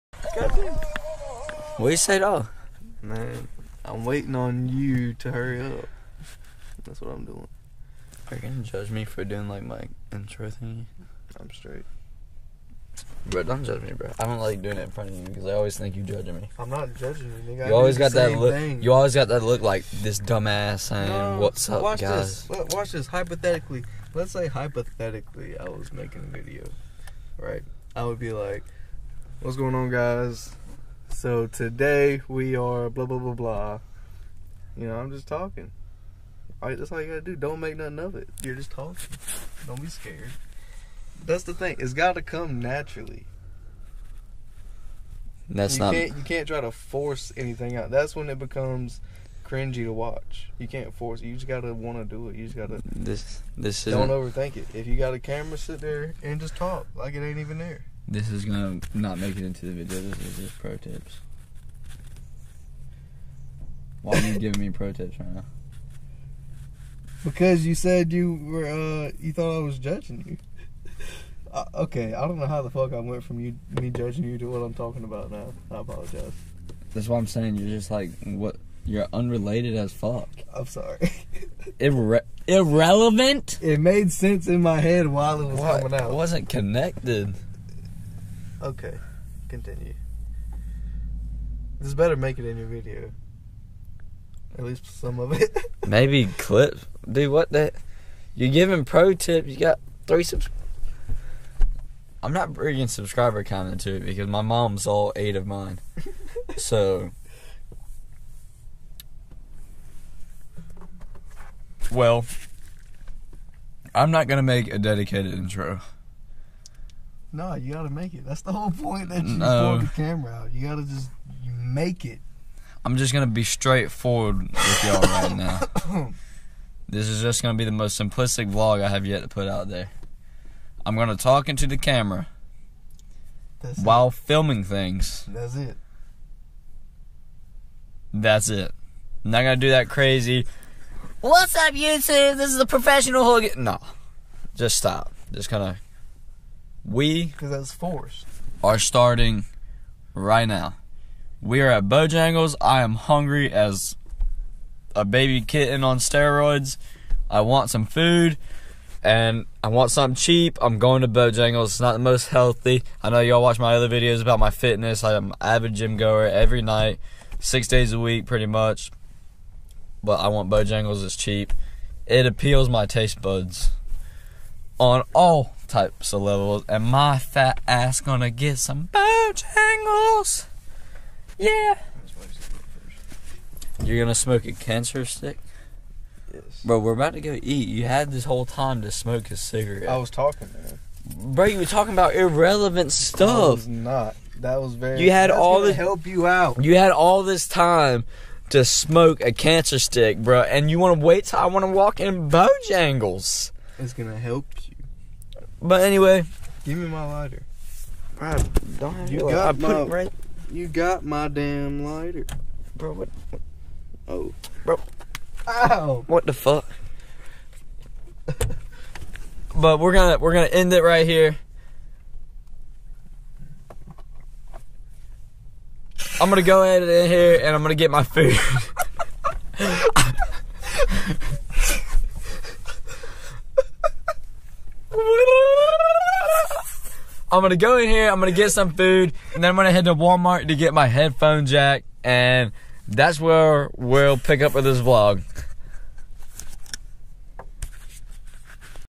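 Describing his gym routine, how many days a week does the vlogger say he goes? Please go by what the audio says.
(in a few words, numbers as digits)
6.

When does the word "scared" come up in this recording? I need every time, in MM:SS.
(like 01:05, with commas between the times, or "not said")
00:39.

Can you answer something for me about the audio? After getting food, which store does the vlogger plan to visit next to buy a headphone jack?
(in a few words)
Walmart.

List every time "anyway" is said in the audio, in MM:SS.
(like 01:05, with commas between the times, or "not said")
03:25.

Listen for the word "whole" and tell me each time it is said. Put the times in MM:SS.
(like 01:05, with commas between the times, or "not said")
01:58, 03:08.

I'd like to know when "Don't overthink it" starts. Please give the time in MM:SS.
00:53.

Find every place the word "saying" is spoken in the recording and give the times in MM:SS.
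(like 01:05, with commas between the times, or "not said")
00:20, 01:17.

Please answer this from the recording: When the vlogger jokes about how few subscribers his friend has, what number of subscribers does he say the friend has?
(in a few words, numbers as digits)
3.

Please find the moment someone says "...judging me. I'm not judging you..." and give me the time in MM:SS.
00:16.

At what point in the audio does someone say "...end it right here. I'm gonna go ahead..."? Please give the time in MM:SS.
03:40.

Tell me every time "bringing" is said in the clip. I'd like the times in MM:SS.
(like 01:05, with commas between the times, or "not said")
01:42.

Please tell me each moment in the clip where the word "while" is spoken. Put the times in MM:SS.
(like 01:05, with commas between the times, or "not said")
01:25, 02:13.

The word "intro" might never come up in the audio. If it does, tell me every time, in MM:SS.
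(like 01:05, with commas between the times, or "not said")
00:10, 01:55.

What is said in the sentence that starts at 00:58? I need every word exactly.
This is gonna not make it into the video.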